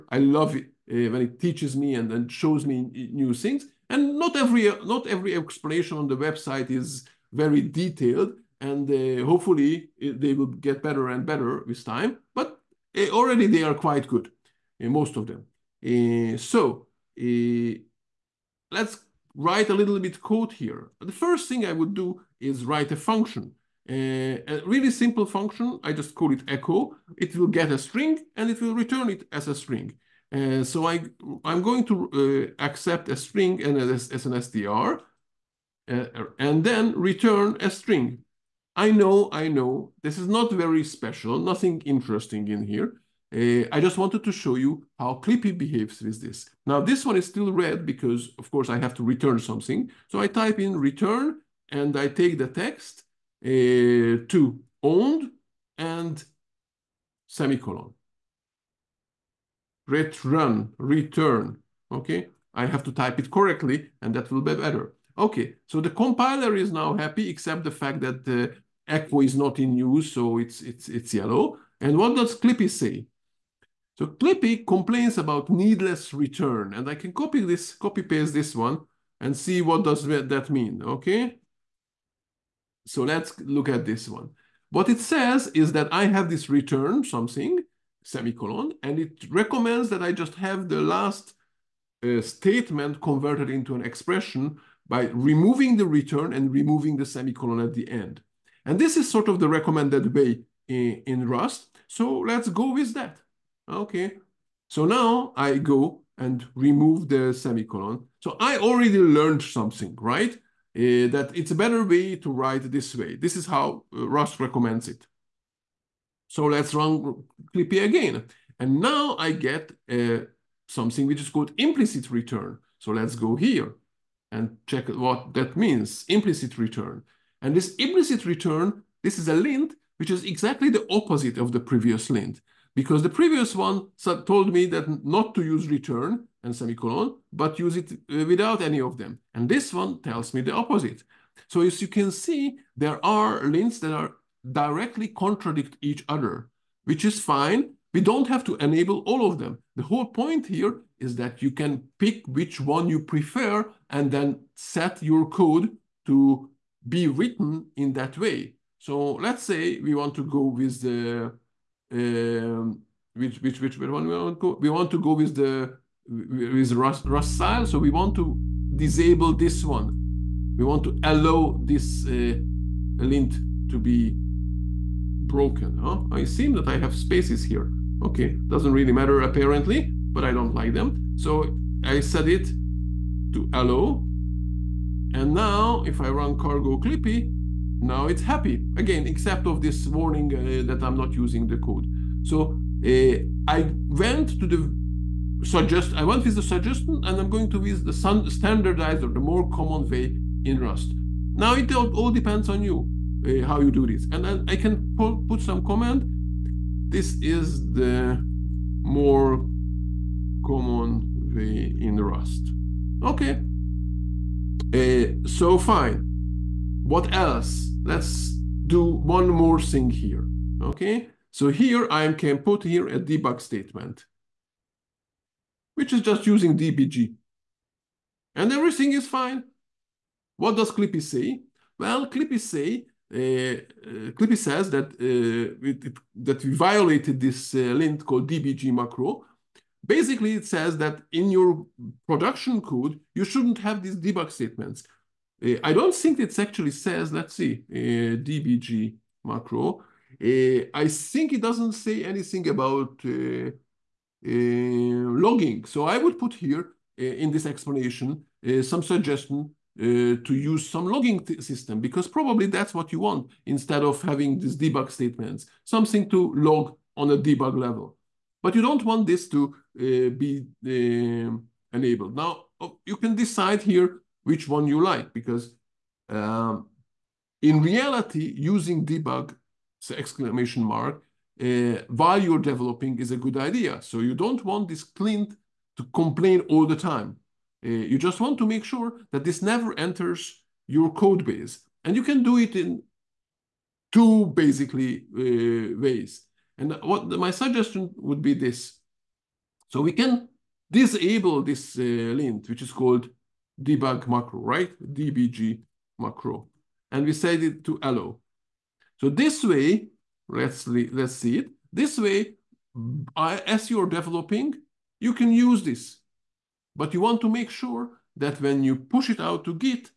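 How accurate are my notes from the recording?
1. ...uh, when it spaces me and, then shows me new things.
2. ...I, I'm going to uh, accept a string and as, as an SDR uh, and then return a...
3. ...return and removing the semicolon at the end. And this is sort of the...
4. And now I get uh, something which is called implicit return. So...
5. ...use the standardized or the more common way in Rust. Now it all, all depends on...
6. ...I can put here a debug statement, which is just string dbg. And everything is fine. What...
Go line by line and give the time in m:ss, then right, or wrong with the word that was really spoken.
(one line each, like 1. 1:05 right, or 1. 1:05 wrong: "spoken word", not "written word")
1. 0:00 wrong: "teaches", not "spaces"
2. 0:30 right
3. 1:35 right
4. 1:58 right
5. 3:17 right
6. 3:41 wrong: "using", not "string".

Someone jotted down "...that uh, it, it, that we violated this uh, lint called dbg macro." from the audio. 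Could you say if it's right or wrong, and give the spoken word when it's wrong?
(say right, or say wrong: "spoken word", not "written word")
right.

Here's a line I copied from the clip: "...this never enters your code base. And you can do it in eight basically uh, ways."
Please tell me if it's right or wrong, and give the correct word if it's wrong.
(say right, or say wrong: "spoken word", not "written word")
wrong: "two", not "eight".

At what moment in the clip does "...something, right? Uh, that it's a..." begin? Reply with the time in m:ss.
1:49.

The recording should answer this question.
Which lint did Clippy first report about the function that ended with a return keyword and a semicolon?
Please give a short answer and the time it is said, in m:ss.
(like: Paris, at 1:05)
needless return, at 1:15.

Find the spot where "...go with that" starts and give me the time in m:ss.
1:42.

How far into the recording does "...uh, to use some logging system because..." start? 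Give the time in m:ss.
4:19.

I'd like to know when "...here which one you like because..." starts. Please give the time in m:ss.
4:33.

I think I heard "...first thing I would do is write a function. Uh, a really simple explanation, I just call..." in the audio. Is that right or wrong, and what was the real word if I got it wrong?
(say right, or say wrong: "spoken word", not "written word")
wrong: "function", not "explanation".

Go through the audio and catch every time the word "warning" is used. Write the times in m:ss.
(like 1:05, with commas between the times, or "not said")
3:09.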